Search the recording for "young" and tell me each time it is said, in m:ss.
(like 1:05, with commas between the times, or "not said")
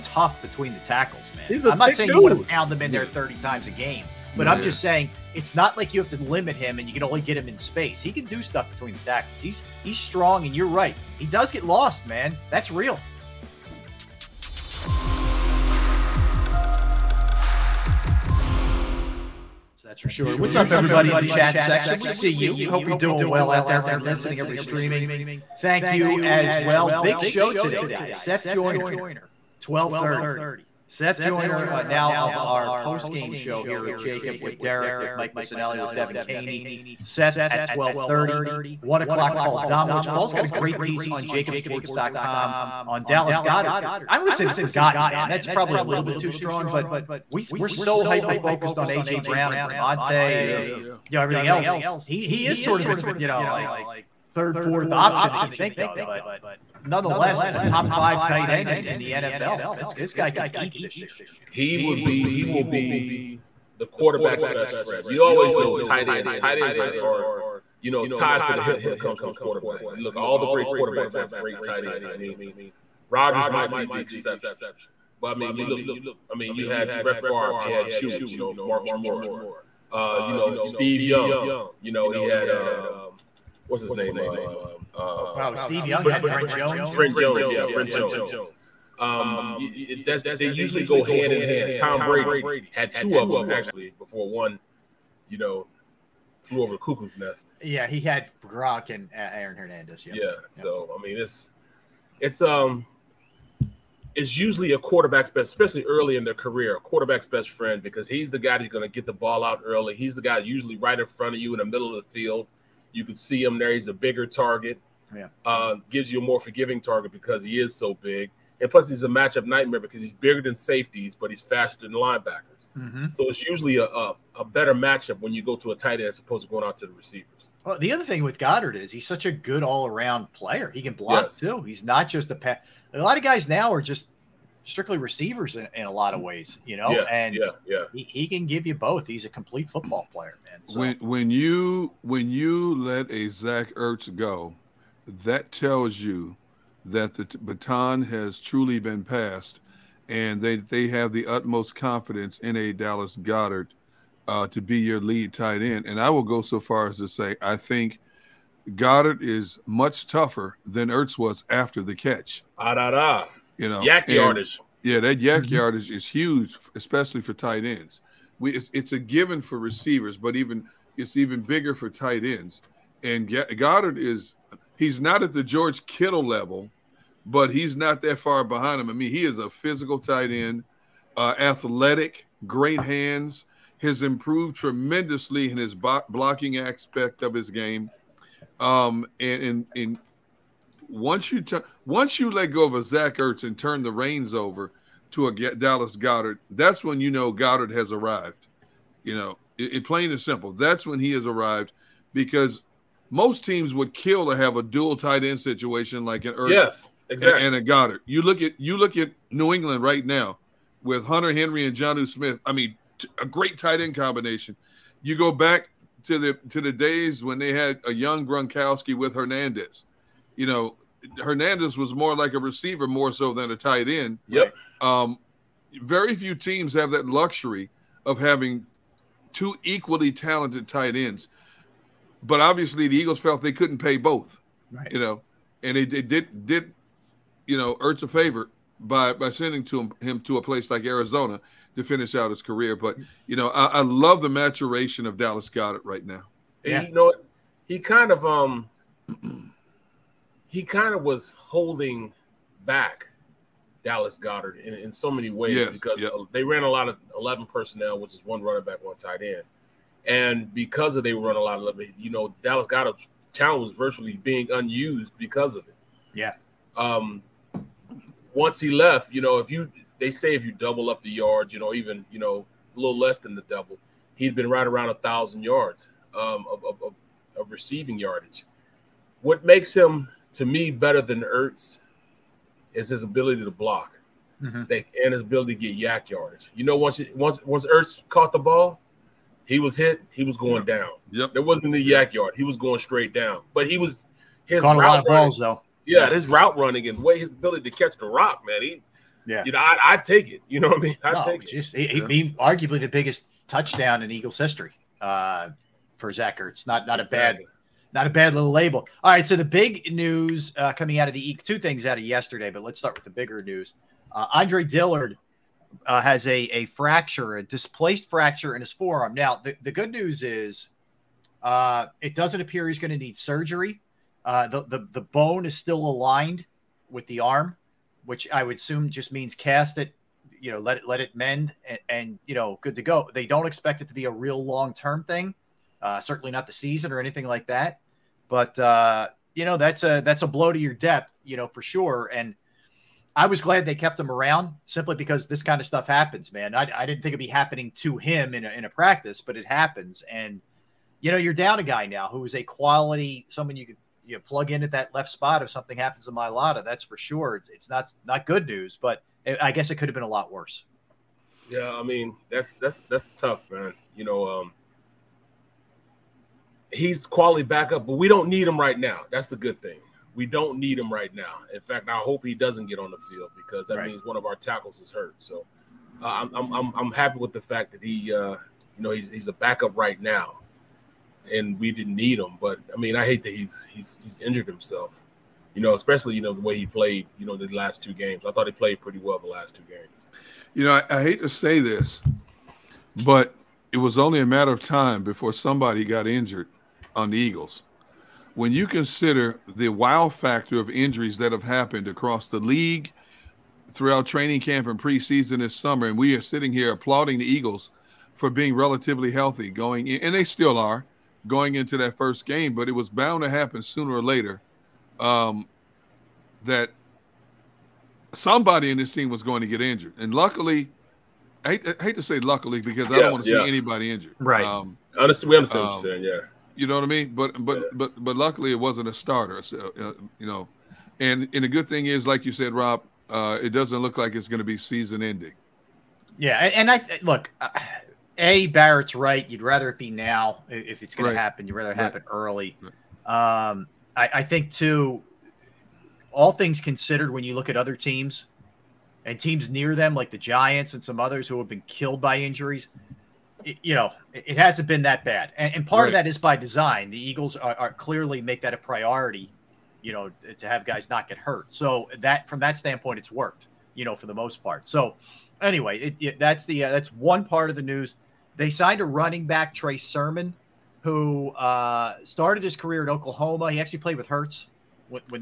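1:21, 1:25, 3:37.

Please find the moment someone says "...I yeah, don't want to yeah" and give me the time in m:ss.
7:02.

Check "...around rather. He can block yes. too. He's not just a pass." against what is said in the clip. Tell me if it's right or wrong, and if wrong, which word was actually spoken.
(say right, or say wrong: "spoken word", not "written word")
wrong: "player", not "rather".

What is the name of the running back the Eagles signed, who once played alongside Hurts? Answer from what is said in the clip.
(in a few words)
Trey Sermon.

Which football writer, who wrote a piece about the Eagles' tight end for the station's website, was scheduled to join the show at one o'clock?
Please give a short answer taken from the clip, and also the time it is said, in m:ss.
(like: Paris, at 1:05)
Paul Domowitch, at 0:39.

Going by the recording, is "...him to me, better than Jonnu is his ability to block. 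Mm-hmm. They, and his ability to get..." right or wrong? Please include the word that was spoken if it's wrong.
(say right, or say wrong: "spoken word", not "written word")
wrong: "Ertz", not "Jonnu".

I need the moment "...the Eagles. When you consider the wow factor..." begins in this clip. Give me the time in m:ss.
6:37.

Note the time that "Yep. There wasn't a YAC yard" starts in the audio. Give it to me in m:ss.
4:51.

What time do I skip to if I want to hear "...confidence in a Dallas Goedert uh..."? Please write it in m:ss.
2:31.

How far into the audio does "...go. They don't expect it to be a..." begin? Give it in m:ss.
5:32.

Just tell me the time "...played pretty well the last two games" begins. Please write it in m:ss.
6:28.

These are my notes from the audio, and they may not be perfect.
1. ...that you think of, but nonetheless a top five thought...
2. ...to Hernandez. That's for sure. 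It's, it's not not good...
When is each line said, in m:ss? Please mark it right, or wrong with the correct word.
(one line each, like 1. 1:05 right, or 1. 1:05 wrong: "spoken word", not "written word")
1. 0:55 wrong: "tight", not "thought"
2. 5:56 wrong: "Mailata", not "Hernandez".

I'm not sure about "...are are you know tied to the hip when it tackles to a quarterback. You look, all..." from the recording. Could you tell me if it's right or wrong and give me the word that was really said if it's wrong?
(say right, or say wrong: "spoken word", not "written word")
wrong: "comes", not "tackles".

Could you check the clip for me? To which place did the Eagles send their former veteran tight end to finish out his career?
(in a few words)
Arizona.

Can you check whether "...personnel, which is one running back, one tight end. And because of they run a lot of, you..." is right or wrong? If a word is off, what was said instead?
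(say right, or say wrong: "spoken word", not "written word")
right.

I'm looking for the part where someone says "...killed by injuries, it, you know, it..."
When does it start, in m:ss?
7:31.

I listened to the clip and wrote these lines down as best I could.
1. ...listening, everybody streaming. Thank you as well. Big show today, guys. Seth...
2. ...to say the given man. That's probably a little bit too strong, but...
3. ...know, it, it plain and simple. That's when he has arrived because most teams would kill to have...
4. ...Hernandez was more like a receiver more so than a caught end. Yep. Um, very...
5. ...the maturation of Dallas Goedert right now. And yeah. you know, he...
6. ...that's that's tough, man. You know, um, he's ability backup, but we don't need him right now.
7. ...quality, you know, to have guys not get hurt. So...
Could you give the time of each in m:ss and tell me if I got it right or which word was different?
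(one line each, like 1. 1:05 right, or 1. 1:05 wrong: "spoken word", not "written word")
1. 0:24 right
2. 0:44 wrong: "forgotten", not "given"
3. 3:19 right
4. 3:41 wrong: "tight", not "caught"
5. 4:04 right
6. 6:02 wrong: "quality", not "ability"
7. 7:38 wrong: "priority", not "quality".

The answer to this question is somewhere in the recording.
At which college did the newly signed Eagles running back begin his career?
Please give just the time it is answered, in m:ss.
7:52.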